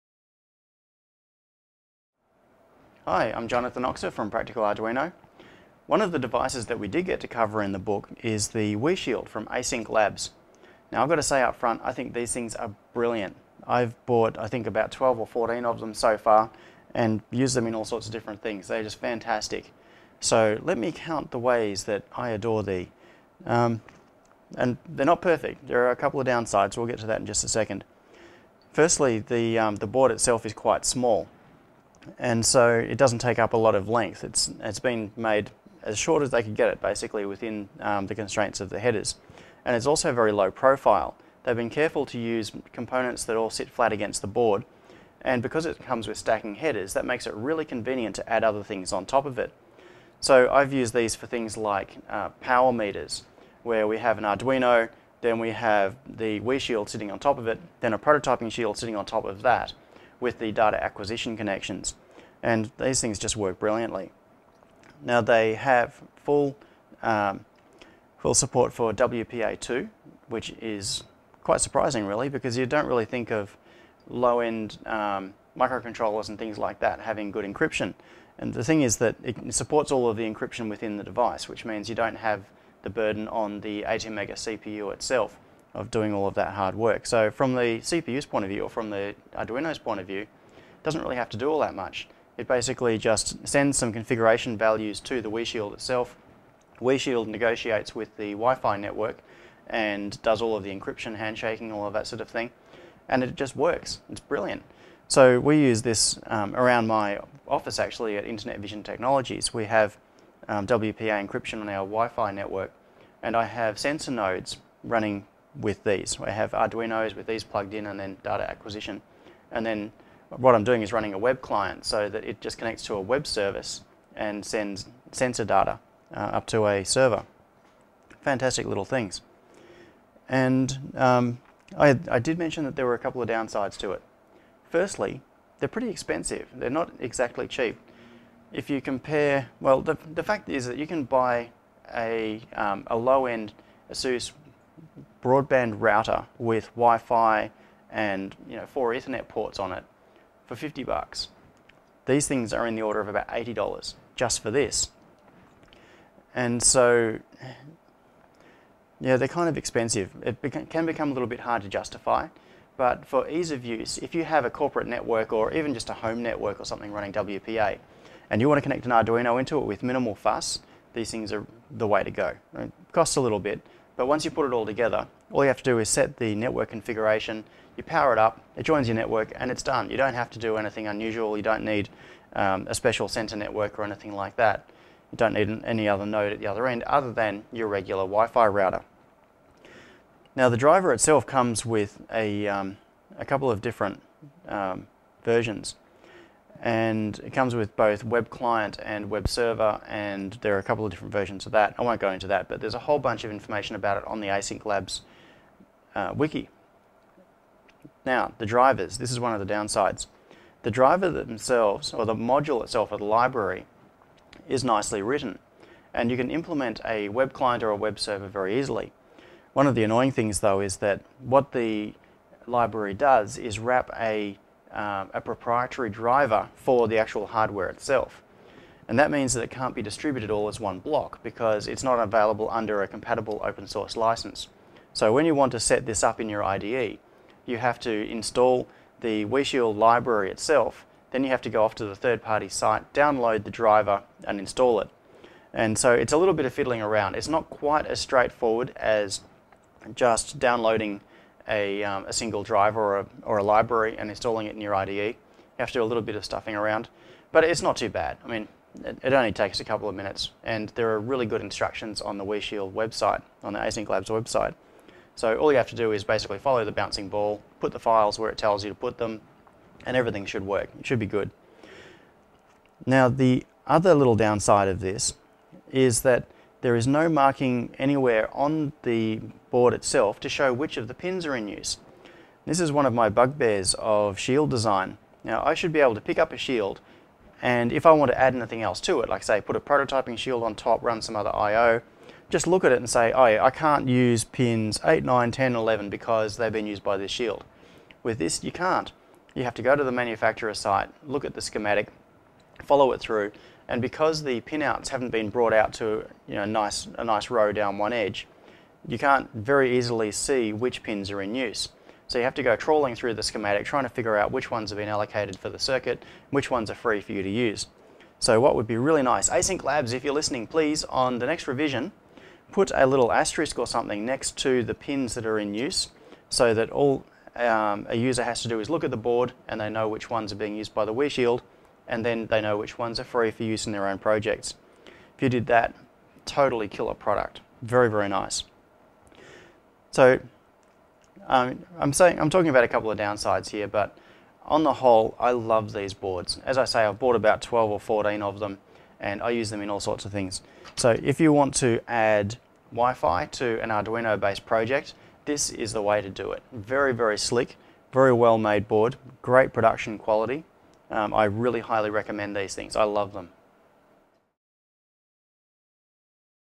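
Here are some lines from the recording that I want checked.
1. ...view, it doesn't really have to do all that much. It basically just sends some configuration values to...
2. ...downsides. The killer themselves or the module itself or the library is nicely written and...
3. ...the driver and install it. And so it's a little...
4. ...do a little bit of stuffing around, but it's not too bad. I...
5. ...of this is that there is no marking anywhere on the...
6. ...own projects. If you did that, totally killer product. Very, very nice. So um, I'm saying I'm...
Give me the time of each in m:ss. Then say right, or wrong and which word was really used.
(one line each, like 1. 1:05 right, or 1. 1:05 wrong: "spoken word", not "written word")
1. 1:30 right
2. 3:29 wrong: "driver", not "killer"
3. 4:03 right
4. 4:15 right
5. 4:34 right
6. 5:33 right.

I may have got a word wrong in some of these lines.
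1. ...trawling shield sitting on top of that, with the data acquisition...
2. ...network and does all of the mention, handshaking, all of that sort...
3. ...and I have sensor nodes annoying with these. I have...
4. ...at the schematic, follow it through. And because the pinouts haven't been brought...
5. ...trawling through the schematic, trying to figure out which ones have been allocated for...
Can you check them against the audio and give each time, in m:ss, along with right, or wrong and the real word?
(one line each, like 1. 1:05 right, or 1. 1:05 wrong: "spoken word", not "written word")
1. 0:57 wrong: "prototyping", not "trawling"
2. 1:38 wrong: "encryption", not "mention"
3. 1:53 wrong: "running", not "annoying"
4. 5:01 right
5. 5:12 right.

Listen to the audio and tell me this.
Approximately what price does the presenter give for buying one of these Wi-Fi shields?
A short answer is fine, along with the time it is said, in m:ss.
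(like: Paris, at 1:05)
$80, at 2:33.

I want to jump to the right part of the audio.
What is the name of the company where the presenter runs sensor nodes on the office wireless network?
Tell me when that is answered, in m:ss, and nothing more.
1:48.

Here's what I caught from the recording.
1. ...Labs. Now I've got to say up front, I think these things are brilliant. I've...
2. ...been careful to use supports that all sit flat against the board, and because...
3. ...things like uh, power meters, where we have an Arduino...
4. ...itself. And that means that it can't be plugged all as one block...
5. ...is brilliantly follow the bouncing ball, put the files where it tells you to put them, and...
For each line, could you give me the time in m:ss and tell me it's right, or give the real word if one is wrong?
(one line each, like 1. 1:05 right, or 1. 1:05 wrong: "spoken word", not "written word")
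1. 0:09 right
2. 0:41 wrong: "components", not "supports"
3. 0:51 right
4. 3:47 wrong: "distributed", not "plugged"
5. 4:25 wrong: "basically", not "brilliantly".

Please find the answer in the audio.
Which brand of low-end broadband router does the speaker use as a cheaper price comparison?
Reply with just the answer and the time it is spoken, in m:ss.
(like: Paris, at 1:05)
ASUS, at 2:23.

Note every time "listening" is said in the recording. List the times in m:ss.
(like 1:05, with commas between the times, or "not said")
5:20.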